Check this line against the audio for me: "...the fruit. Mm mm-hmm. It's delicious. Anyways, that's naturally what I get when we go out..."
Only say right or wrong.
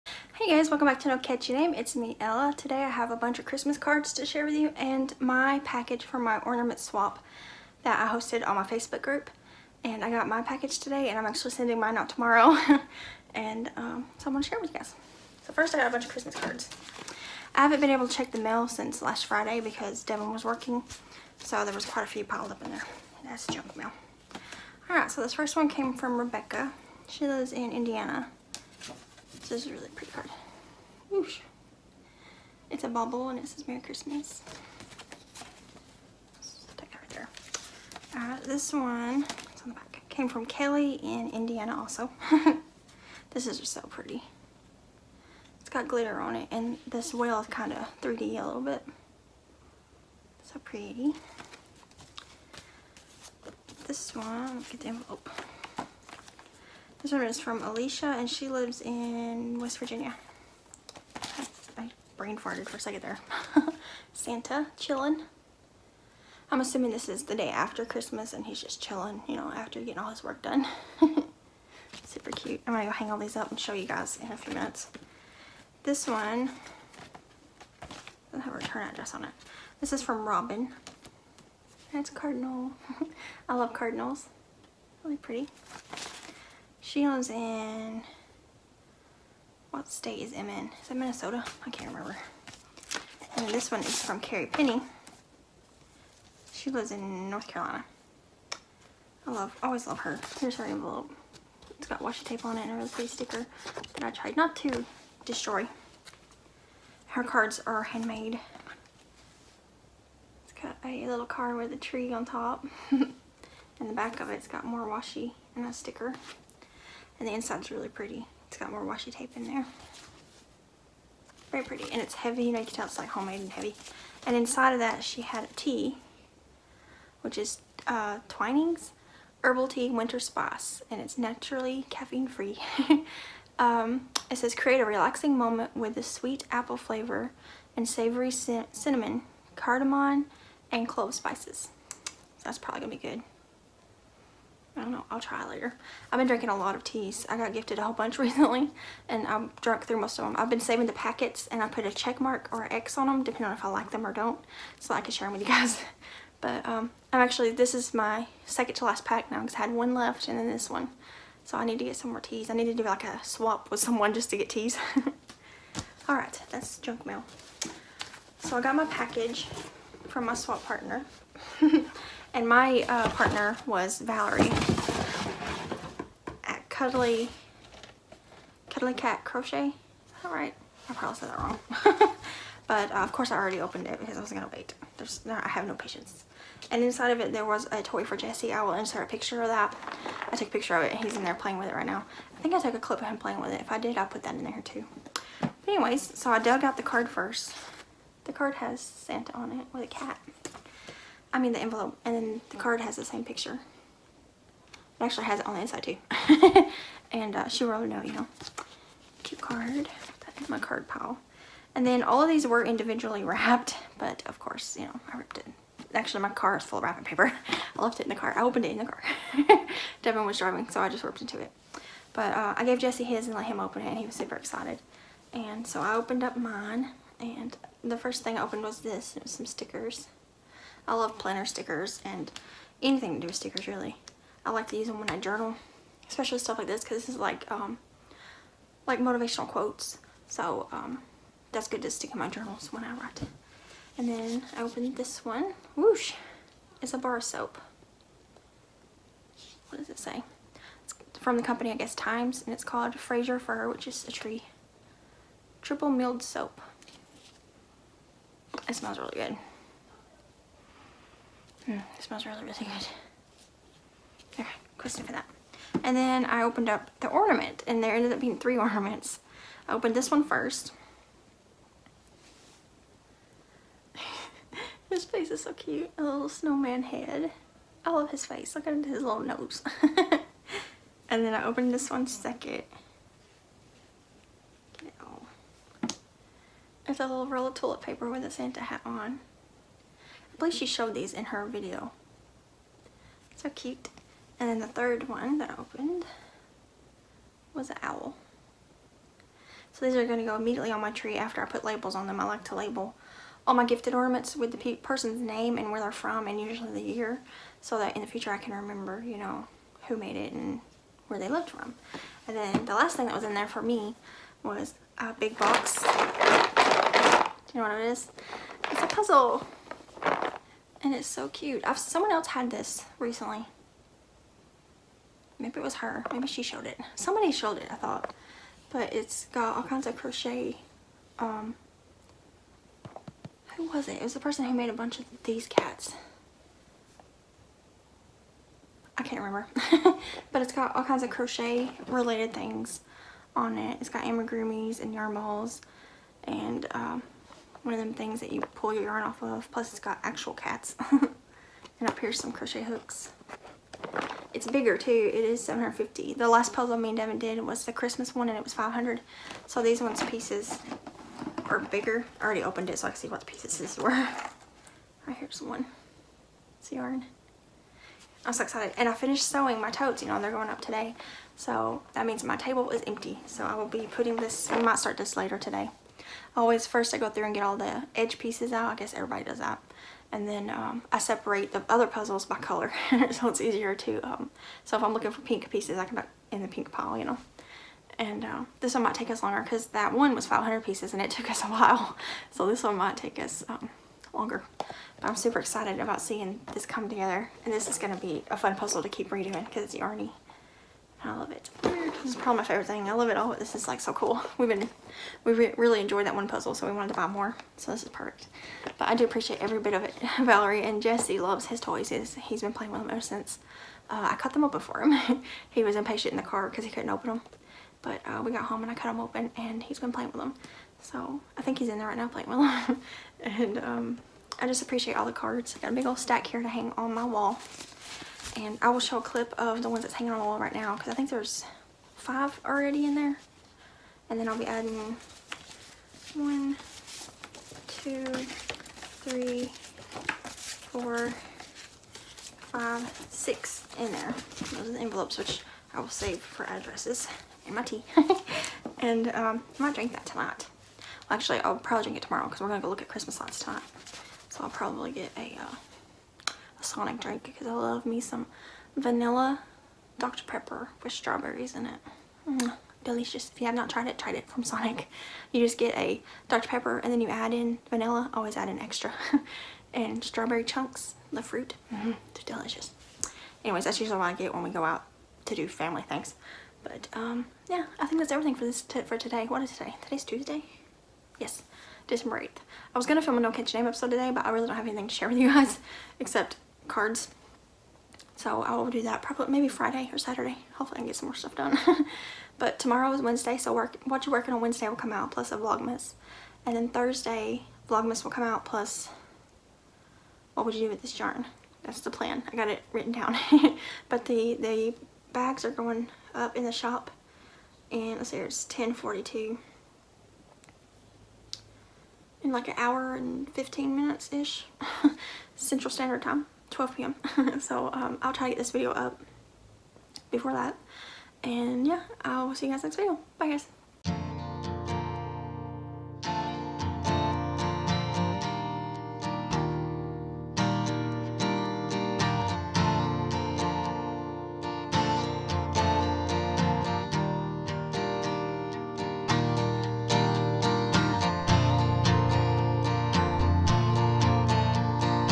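wrong.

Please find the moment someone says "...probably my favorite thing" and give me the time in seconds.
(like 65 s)
402 s.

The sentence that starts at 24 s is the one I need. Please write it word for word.
Alright, so this first one came from Rebecca.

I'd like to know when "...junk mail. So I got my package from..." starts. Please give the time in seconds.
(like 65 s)
166 s.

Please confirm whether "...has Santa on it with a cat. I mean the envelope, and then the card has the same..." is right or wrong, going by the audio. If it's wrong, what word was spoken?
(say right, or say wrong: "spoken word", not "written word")
right.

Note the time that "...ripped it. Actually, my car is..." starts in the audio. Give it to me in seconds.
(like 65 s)
215 s.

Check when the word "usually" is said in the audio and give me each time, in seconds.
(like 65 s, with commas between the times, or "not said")
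306 s, 473 s.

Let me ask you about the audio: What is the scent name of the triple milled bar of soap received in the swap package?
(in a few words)
Fraser Fir.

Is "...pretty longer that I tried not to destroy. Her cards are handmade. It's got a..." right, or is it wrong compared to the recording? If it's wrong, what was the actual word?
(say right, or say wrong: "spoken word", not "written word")
wrong: "sticker", not "longer".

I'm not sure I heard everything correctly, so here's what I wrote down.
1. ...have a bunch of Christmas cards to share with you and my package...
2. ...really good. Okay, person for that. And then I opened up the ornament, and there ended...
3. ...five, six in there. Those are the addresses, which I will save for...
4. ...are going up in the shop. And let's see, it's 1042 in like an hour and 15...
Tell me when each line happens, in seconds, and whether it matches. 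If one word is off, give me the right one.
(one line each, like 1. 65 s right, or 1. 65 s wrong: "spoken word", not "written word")
1. 2 s right
2. 262 s wrong: "question", not "person"
3. 442 s wrong: "envelopes", not "addresses"
4. 505 s right.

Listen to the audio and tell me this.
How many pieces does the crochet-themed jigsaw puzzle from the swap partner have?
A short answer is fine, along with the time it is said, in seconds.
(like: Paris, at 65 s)
750, at 355 s.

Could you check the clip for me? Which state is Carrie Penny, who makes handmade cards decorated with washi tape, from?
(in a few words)
North Carolina.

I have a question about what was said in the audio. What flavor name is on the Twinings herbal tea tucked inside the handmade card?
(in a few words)
Winter Spice.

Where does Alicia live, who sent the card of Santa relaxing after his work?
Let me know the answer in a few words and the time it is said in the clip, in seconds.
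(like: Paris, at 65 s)
West Virginia, at 59 s.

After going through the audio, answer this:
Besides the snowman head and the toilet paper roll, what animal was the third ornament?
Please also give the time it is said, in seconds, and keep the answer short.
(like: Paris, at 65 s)
owl, at 297 s.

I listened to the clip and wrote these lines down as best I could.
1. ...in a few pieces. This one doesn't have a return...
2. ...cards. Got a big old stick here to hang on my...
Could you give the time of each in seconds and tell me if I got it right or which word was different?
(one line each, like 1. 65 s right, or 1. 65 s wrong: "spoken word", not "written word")
1. 74 s wrong: "minutes", not "pieces"
2. 425 s wrong: "stack", not "stick".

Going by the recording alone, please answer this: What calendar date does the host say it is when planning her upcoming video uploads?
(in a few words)
December 8th.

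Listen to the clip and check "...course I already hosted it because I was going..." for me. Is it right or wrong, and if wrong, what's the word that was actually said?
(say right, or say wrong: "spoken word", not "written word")
wrong: "opened", not "hosted".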